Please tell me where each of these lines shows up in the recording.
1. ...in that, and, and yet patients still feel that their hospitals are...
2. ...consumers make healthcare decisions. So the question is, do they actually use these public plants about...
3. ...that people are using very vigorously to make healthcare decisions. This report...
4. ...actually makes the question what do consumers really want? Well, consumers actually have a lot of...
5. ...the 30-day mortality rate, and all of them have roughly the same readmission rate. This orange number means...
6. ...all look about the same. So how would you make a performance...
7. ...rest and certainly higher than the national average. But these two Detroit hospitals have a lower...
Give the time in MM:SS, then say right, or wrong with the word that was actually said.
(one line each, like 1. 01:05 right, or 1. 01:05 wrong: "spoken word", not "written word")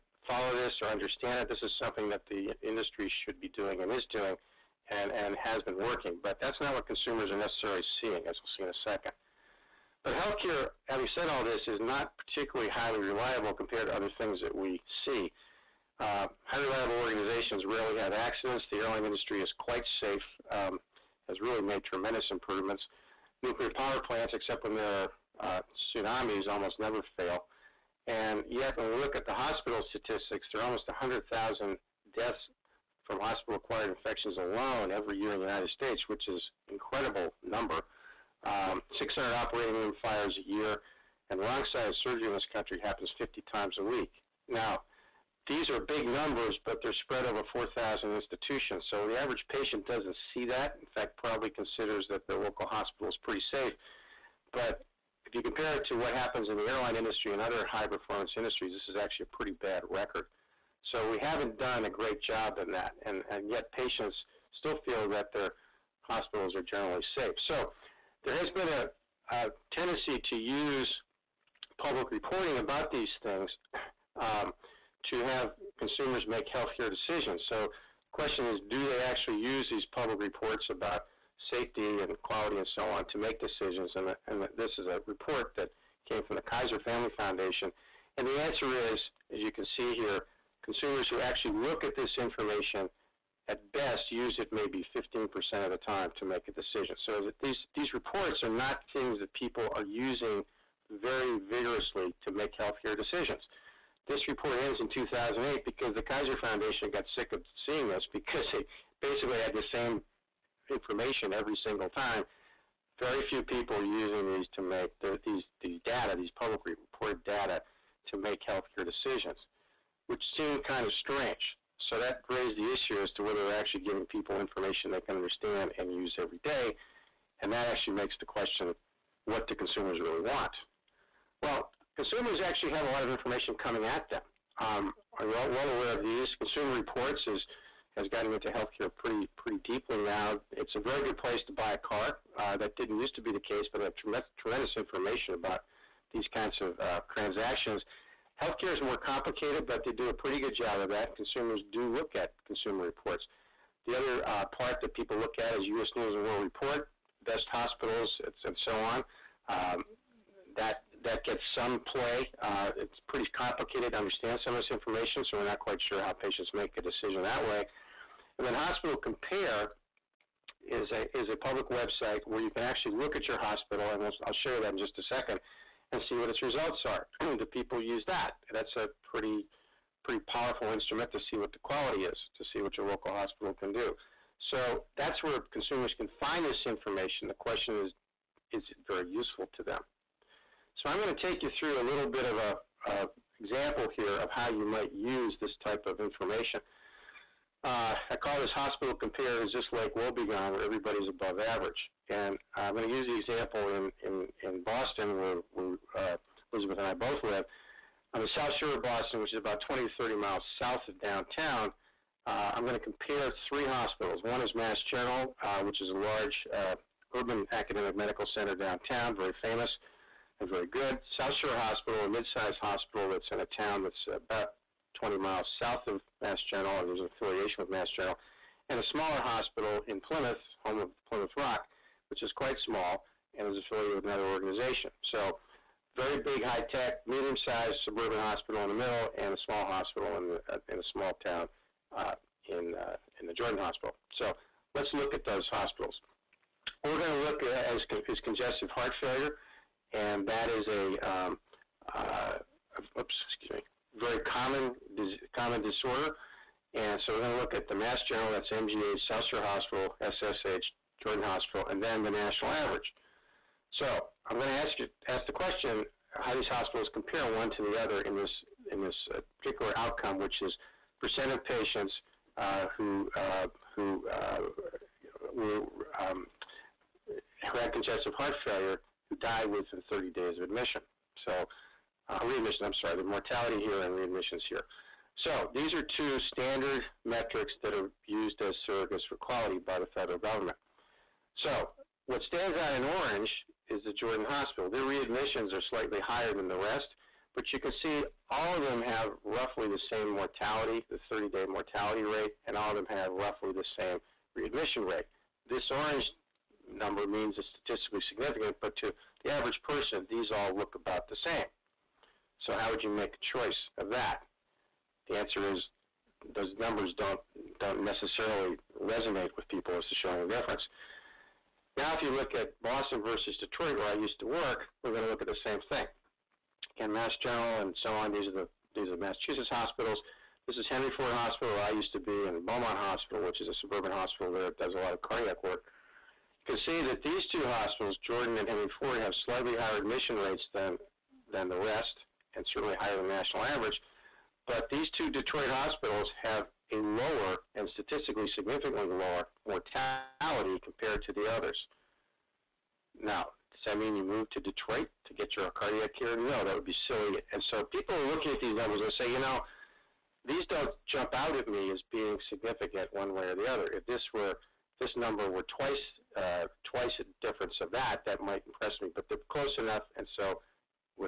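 1. 01:02 right
2. 01:15 wrong: "reports", not "plants"
3. 01:39 right
4. 02:07 right
5. 05:00 right
6. 05:10 wrong: "choice", not "performance"
7. 05:41 right.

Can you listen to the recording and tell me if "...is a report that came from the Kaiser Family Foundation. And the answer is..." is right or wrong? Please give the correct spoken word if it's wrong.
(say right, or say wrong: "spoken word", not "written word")
right.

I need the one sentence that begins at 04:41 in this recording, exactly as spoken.
So uh, readmissions, I'm sorry, the mortality here and readmissions here.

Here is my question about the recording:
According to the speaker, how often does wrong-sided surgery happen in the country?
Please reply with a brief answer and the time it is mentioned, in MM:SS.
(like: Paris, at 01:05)
50 times a week, at 00:43.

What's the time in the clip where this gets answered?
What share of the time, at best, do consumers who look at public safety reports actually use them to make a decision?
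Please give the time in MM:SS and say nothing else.
01:34.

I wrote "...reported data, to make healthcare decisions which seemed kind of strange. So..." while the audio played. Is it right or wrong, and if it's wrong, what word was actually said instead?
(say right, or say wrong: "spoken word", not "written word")
right.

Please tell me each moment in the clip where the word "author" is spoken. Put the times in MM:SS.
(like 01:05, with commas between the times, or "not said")
not said.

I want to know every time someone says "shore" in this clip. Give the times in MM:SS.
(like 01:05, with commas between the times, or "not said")
03:28, 03:41, 04:19.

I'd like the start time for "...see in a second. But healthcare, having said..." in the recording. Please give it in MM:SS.
00:08.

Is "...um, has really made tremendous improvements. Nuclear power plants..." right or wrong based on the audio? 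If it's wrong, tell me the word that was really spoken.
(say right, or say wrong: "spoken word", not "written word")
right.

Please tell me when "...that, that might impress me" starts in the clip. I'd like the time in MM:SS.
06:07.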